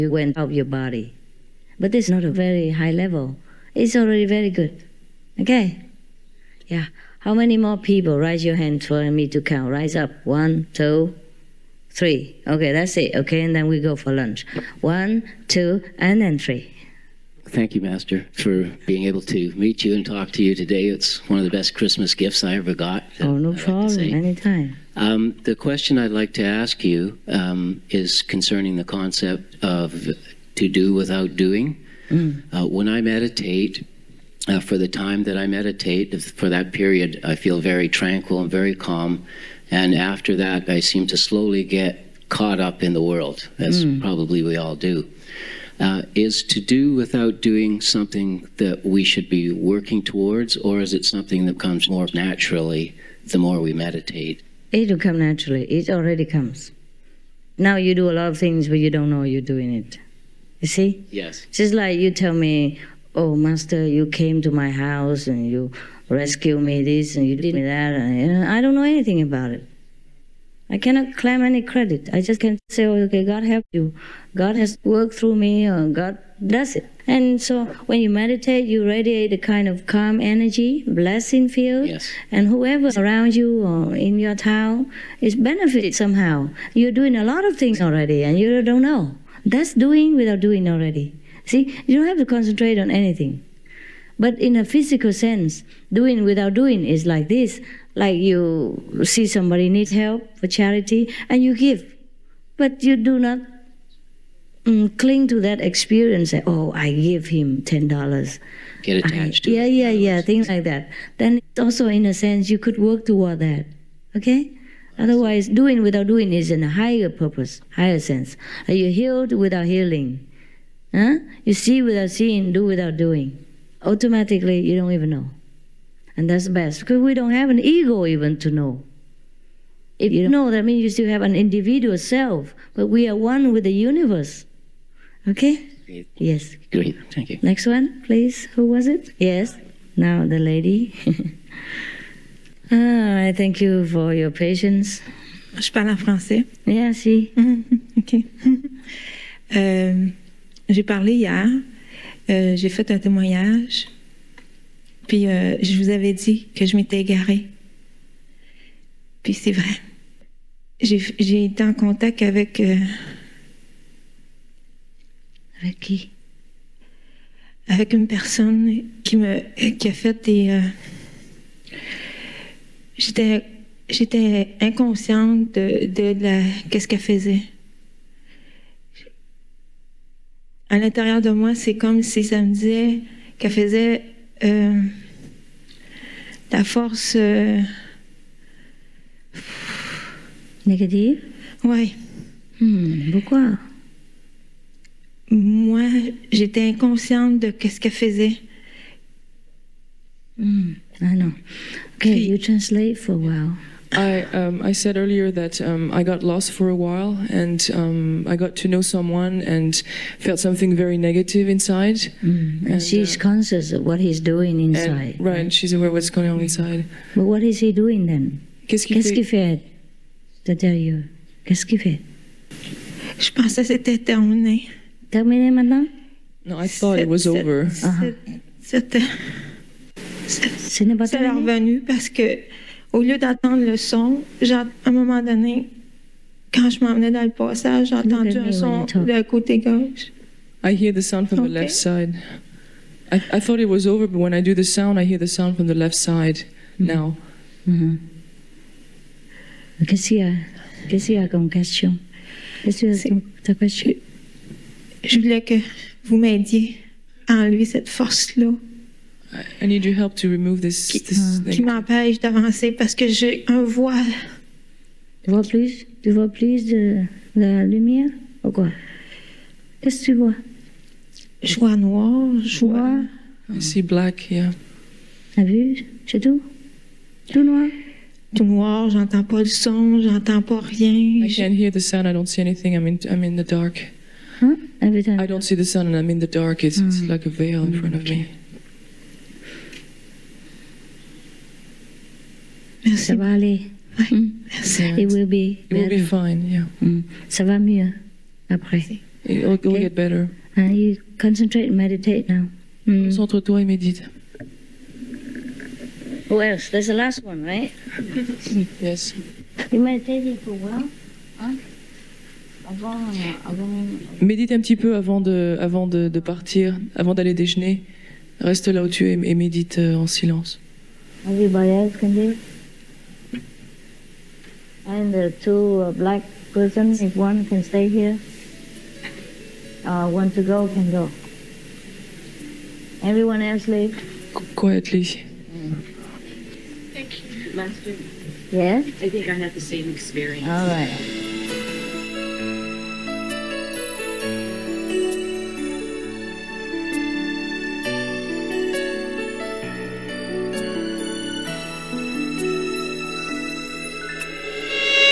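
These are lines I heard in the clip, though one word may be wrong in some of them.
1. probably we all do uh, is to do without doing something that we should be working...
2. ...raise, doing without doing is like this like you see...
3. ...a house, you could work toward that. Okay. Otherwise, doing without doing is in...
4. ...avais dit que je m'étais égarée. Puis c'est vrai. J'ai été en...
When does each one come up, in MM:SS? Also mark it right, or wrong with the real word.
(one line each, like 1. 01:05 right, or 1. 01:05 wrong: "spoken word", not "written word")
1. 00:44 right
2. 01:35 wrong: "sense", not "raise"
3. 01:52 wrong: "sense", not "house"
4. 02:35 right.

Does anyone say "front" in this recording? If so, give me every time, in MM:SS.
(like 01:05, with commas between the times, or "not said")
04:47.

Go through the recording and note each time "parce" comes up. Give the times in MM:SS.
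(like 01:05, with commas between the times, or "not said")
03:51, 04:22.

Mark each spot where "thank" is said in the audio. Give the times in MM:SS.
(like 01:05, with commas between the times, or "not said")
00:17, 02:17, 02:23, 05:35.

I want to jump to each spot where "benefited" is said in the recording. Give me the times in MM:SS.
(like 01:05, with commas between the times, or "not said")
01:25.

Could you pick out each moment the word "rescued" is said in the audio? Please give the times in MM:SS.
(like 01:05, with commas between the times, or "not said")
01:06.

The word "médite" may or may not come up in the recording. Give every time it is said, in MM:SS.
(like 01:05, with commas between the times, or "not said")
05:03, 05:14, 05:19.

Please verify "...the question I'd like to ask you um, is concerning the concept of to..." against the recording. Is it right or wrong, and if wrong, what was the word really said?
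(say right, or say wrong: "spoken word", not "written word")
right.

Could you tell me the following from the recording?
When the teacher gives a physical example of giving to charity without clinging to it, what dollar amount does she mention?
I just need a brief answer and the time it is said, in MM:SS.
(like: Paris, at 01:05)
10 dollars, at 01:47.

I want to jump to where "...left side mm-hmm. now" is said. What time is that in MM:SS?
04:05.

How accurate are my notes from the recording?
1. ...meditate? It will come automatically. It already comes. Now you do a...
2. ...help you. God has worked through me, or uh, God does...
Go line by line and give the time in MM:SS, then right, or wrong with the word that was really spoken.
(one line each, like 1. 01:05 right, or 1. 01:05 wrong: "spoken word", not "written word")
1. 00:53 wrong: "naturally", not "automatically"
2. 01:13 right.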